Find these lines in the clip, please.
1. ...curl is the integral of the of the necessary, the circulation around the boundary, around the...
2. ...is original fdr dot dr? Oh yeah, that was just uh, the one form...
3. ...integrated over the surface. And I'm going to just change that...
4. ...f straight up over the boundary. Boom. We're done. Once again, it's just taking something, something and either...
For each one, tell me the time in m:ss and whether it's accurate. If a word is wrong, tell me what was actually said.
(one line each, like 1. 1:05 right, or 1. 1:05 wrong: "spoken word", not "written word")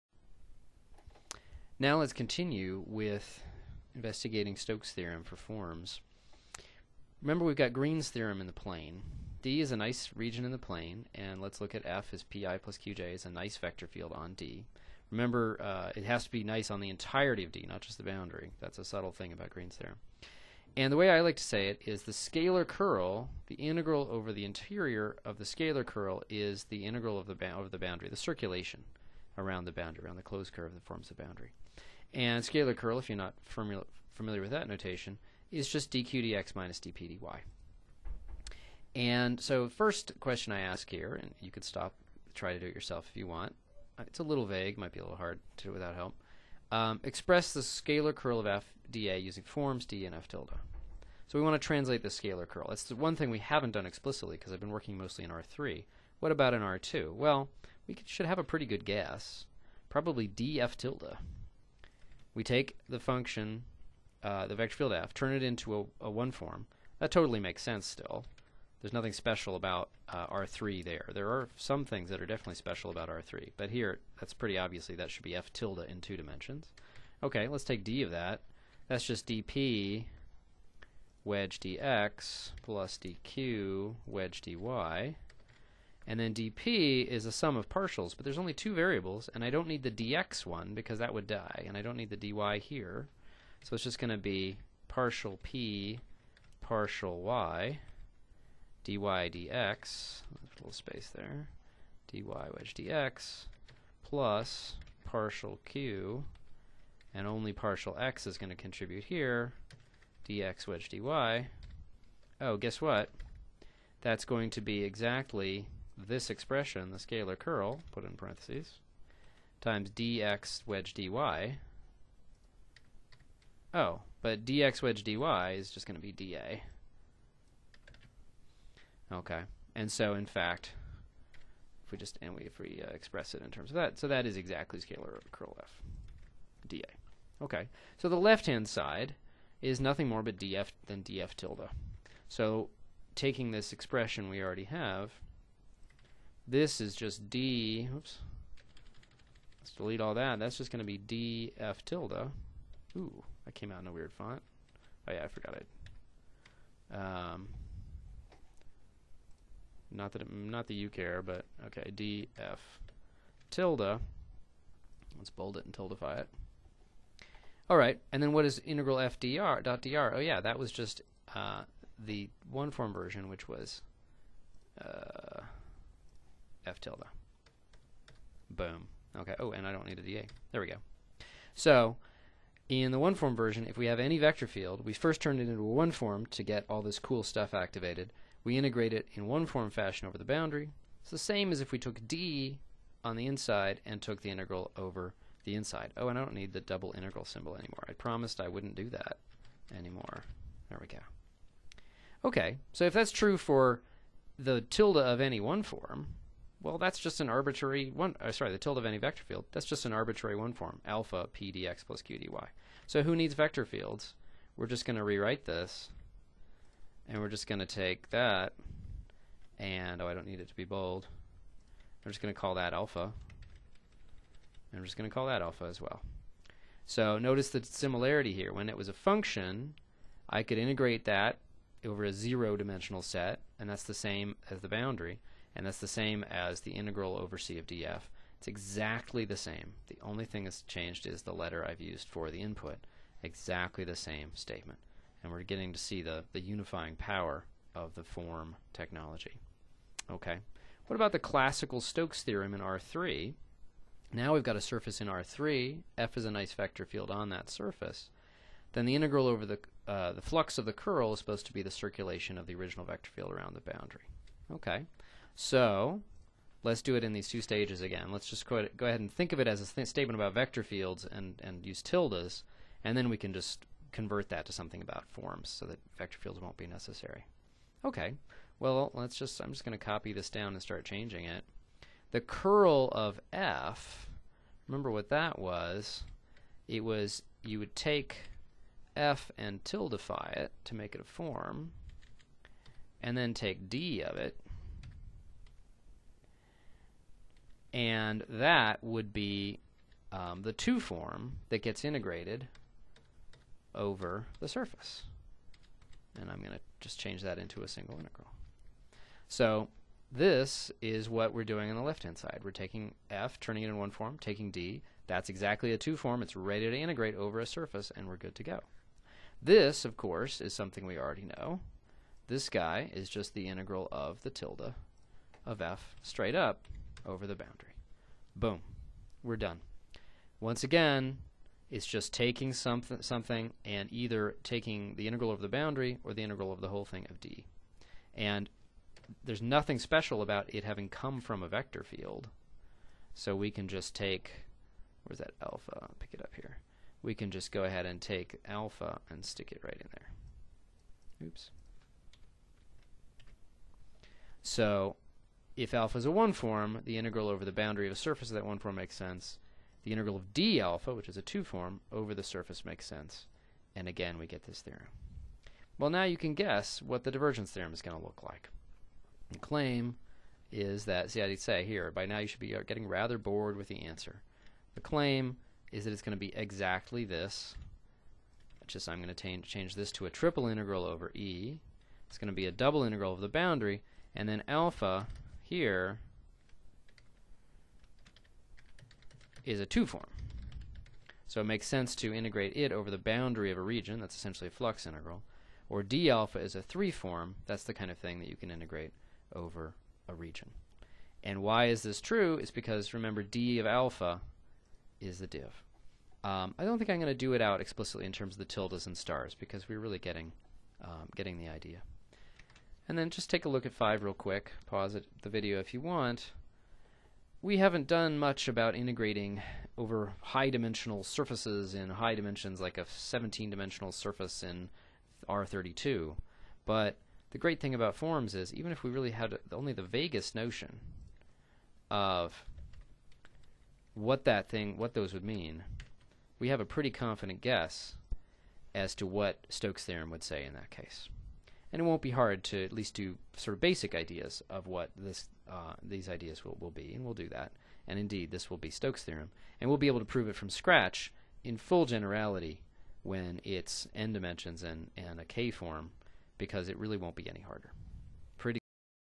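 1. 0:25 wrong: "boundary", not "necessary"
2. 2:48 wrong: "integral", not "original"
3. 5:01 right
4. 5:25 right.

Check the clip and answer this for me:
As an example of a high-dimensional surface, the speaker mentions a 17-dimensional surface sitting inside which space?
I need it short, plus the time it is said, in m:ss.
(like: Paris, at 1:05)
R32, at 7:05.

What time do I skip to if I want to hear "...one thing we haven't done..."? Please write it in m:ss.
0:52.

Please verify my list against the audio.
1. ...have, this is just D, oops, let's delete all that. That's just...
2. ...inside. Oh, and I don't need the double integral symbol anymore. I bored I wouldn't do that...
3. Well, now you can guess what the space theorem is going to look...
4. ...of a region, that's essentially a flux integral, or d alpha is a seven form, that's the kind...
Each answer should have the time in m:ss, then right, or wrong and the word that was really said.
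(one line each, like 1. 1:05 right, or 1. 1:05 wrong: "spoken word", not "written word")
1. 2:24 right
2. 3:15 wrong: "promised", not "bored"
3. 6:05 wrong: "divergence", not "space"
4. 6:33 wrong: "three", not "seven".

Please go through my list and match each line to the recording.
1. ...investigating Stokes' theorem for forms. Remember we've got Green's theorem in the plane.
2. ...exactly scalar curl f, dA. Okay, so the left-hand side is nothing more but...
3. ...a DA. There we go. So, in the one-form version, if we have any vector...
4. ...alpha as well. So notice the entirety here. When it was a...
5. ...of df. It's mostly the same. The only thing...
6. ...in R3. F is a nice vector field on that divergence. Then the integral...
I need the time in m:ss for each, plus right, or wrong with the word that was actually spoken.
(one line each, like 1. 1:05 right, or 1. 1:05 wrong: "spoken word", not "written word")
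1. 0:03 right
2. 2:14 right
3. 2:59 right
4. 3:45 wrong: "similarity", not "entirety"
5. 3:57 wrong: "exactly", not "mostly"
6. 4:15 wrong: "surface", not "divergence".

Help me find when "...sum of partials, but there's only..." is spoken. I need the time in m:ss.
1:27.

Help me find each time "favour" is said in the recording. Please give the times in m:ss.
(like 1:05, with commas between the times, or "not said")
not said.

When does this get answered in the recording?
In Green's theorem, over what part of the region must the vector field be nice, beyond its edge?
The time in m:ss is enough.
0:16.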